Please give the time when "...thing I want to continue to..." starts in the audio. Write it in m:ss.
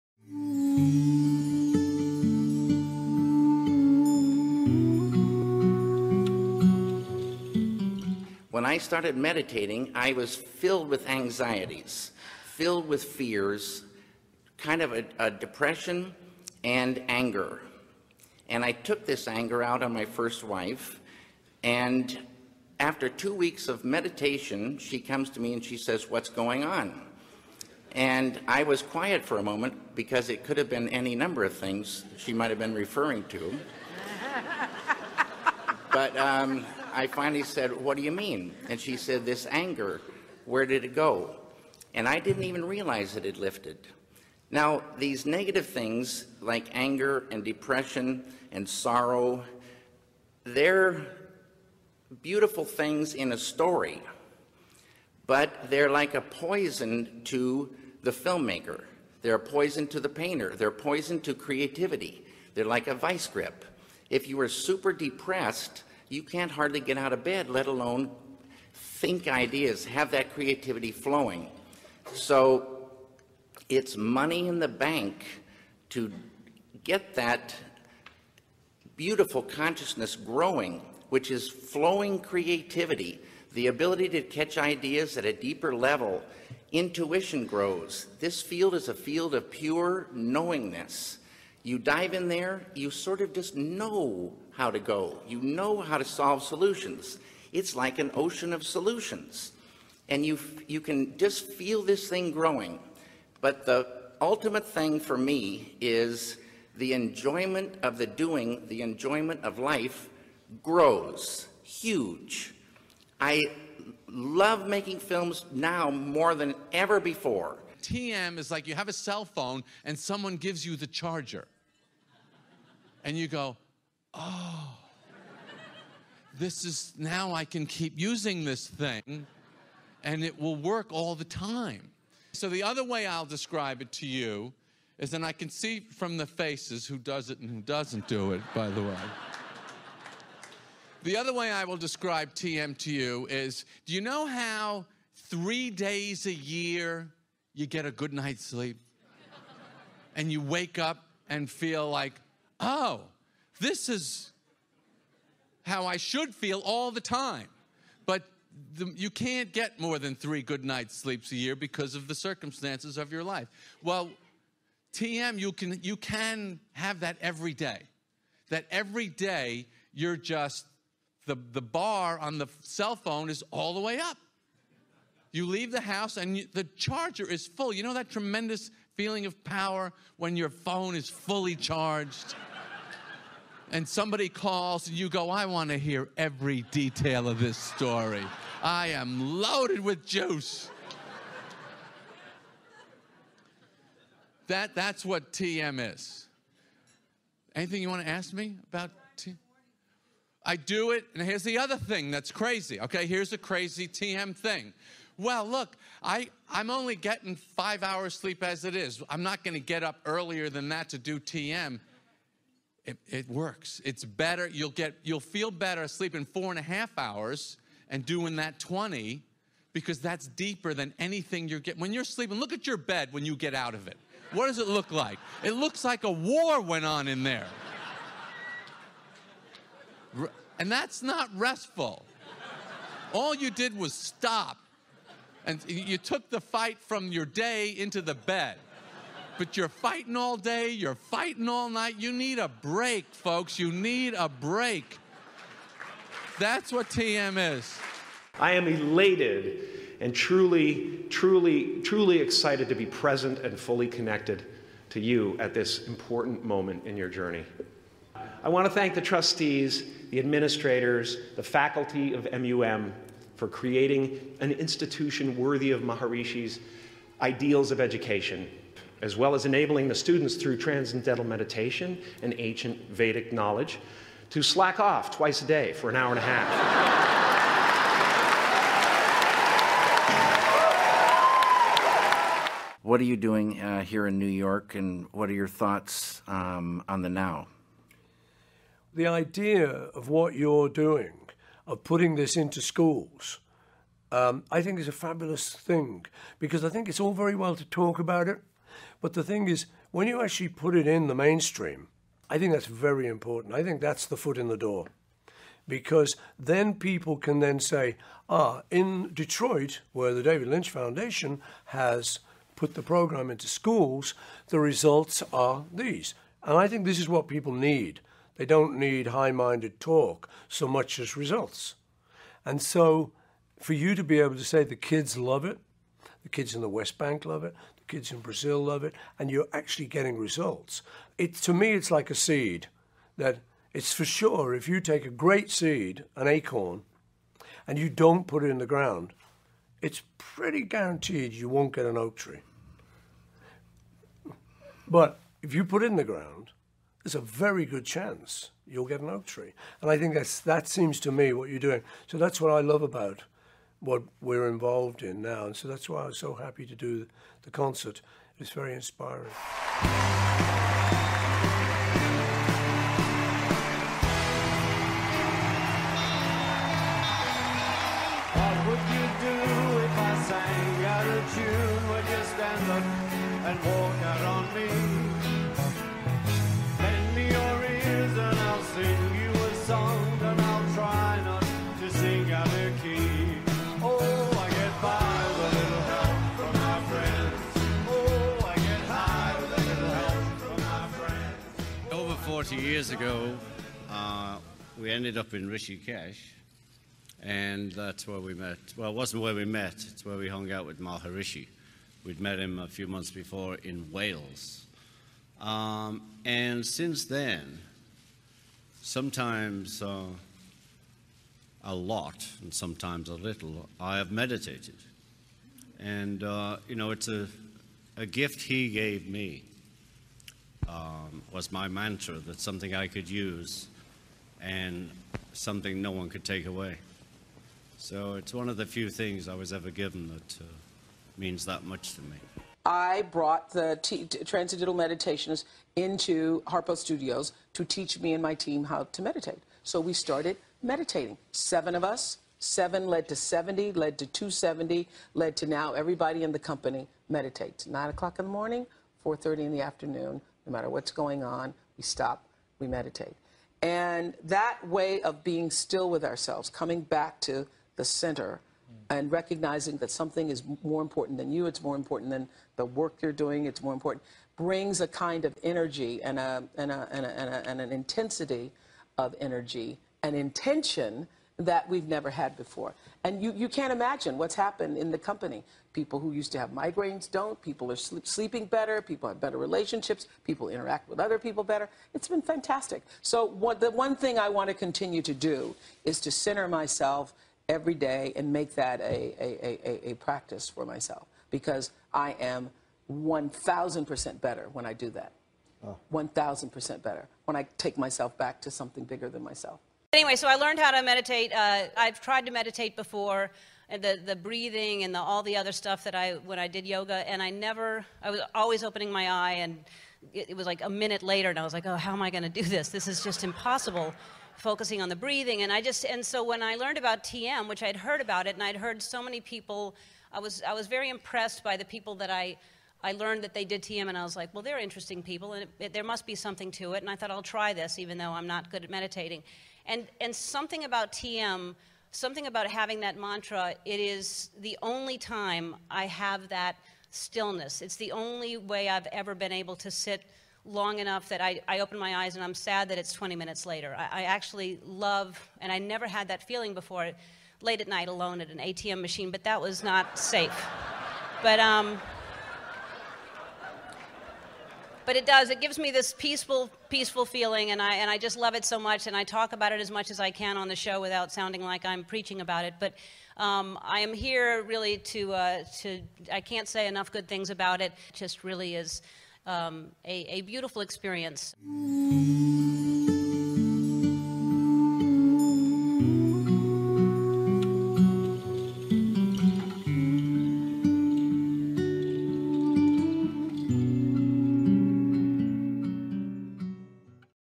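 8:03.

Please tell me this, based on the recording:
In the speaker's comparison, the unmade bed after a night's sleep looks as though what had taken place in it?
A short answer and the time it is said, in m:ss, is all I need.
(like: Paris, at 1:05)
a war, at 3:46.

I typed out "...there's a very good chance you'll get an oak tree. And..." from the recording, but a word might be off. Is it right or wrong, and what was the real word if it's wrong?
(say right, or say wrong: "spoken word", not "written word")
right.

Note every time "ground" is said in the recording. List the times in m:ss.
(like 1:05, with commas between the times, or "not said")
5:38, 5:46.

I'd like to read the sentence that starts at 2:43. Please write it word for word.
Well, TM, you can, you can have that every day.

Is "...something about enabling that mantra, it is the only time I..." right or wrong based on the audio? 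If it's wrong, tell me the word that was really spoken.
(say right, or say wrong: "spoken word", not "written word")
wrong: "having", not "enabling".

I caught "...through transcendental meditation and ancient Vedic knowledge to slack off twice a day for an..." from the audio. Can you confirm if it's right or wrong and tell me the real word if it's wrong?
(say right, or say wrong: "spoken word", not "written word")
right.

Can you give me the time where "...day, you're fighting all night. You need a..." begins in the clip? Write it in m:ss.
4:00.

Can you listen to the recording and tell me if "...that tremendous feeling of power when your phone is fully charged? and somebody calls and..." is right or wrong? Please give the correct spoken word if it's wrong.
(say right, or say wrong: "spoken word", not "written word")
right.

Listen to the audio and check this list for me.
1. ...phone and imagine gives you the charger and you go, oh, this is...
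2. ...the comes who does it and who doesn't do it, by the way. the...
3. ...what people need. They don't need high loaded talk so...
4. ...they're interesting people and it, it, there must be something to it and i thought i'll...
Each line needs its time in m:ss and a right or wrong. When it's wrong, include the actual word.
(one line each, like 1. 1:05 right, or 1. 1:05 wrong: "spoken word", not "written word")
1. 1:59 wrong: "someone", not "imagine"
2. 2:16 wrong: "faces", not "comes"
3. 5:17 wrong: "minded", not "loaded"
4. 8:44 right.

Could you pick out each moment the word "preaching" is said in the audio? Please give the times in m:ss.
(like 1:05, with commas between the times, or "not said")
9:21.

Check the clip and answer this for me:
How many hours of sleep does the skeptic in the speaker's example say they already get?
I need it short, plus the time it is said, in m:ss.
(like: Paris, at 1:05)
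5, at 3:27.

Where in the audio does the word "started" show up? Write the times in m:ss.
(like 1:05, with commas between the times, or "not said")
0:08, 7:19.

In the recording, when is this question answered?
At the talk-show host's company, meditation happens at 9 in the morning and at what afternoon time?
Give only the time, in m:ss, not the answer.
7:29.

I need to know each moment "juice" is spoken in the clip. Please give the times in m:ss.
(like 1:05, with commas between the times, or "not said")
3:10.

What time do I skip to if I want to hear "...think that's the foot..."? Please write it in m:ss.
5:03.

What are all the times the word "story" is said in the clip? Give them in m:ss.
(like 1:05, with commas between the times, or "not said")
0:53, 3:07.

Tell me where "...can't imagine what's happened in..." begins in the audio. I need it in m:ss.
7:53.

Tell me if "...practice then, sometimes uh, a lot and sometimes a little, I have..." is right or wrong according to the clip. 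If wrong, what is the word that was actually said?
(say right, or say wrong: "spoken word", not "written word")
wrong: "since", not "practice".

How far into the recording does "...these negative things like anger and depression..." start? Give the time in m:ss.
0:44.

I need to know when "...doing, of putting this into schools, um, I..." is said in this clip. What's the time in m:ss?
4:50.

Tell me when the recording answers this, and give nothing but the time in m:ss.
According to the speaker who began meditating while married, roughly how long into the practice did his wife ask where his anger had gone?
0:23.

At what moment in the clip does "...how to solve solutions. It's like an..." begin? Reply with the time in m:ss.
1:35.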